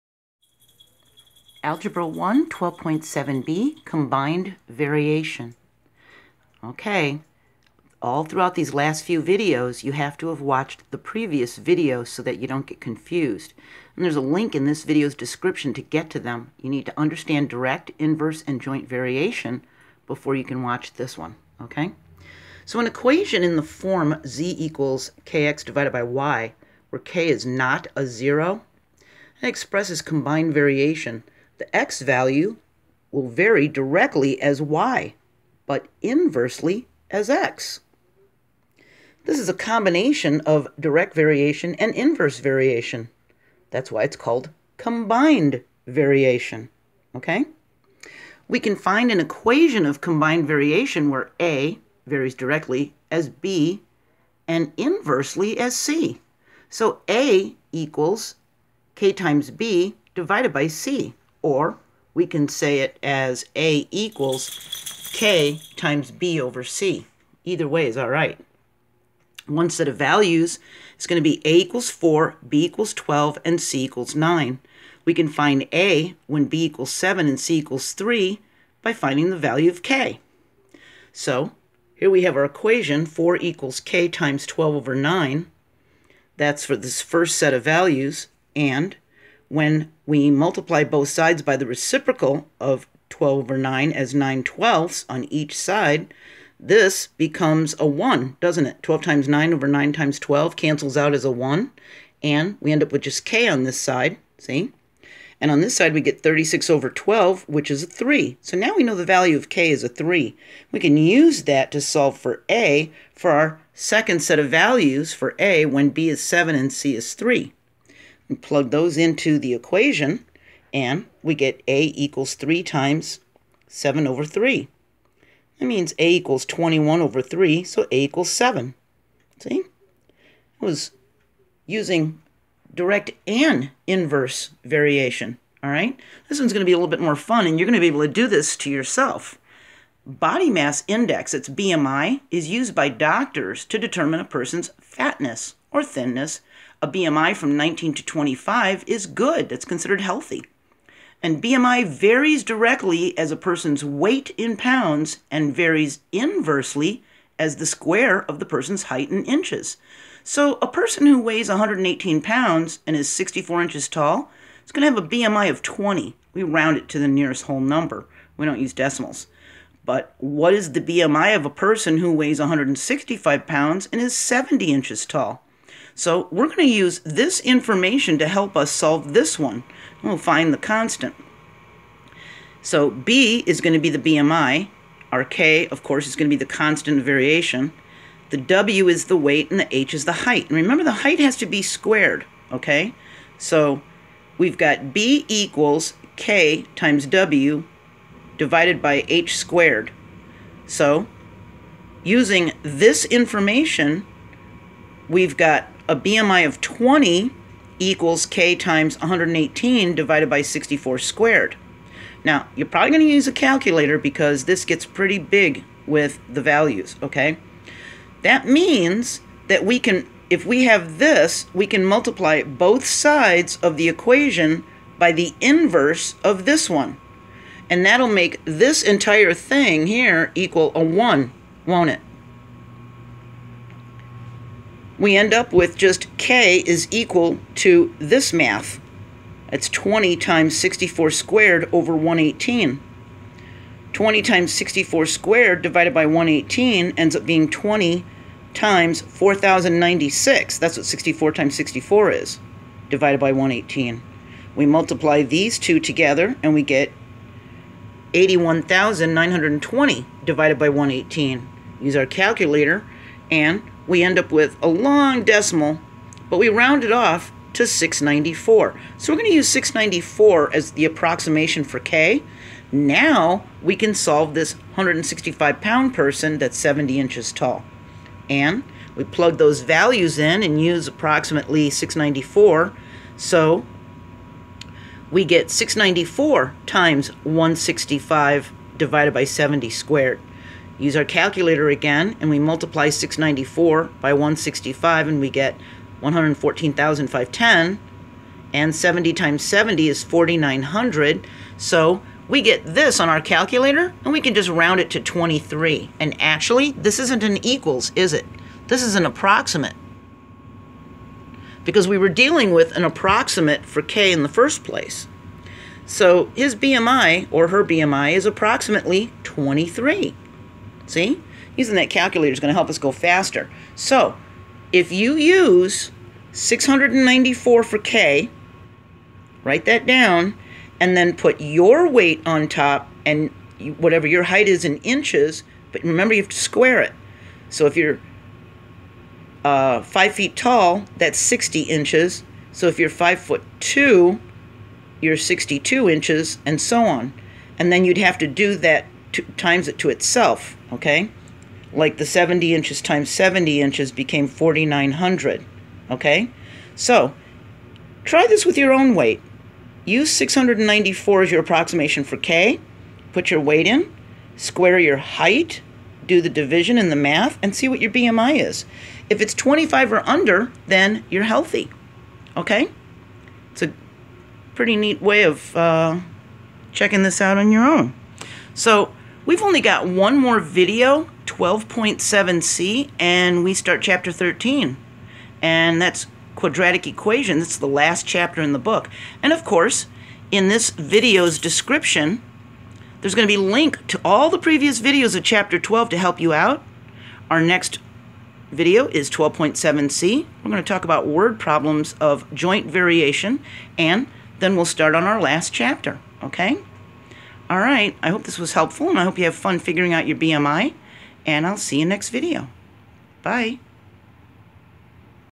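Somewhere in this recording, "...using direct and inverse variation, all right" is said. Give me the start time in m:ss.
2:11.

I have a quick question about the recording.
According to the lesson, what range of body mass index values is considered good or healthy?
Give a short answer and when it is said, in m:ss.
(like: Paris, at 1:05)
19 to 25, at 2:27.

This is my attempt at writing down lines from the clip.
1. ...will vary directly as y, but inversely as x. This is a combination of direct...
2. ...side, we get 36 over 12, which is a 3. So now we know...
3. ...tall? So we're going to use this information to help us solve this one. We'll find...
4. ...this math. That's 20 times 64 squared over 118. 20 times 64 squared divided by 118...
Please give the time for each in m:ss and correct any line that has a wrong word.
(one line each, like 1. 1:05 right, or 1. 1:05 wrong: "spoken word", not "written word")
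1. 0:33 right
2. 1:45 right
3. 2:55 right
4. 3:57 right.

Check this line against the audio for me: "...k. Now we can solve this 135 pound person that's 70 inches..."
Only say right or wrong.
wrong.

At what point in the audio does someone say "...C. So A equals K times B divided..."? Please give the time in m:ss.
0:55.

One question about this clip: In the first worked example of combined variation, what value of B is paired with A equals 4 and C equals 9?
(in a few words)
12.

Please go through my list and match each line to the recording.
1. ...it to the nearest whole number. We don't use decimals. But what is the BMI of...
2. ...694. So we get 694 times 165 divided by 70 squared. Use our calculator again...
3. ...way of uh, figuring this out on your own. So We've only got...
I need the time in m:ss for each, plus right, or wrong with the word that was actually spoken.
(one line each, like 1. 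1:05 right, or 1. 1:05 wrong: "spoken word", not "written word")
1. 2:46 right
2. 4:41 right
3. 6:15 wrong: "checking", not "figuring".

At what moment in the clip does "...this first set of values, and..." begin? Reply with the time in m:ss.
1:26.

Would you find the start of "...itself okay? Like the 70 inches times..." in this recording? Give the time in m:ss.
5:49.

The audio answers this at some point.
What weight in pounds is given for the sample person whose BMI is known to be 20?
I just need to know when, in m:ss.
2:41.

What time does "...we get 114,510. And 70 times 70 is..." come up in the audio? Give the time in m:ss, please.
4:55.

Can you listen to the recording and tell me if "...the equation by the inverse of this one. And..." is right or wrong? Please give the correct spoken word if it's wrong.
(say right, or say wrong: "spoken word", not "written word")
right.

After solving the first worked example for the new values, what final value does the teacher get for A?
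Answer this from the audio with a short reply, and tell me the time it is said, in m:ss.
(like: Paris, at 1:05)
7, at 2:07.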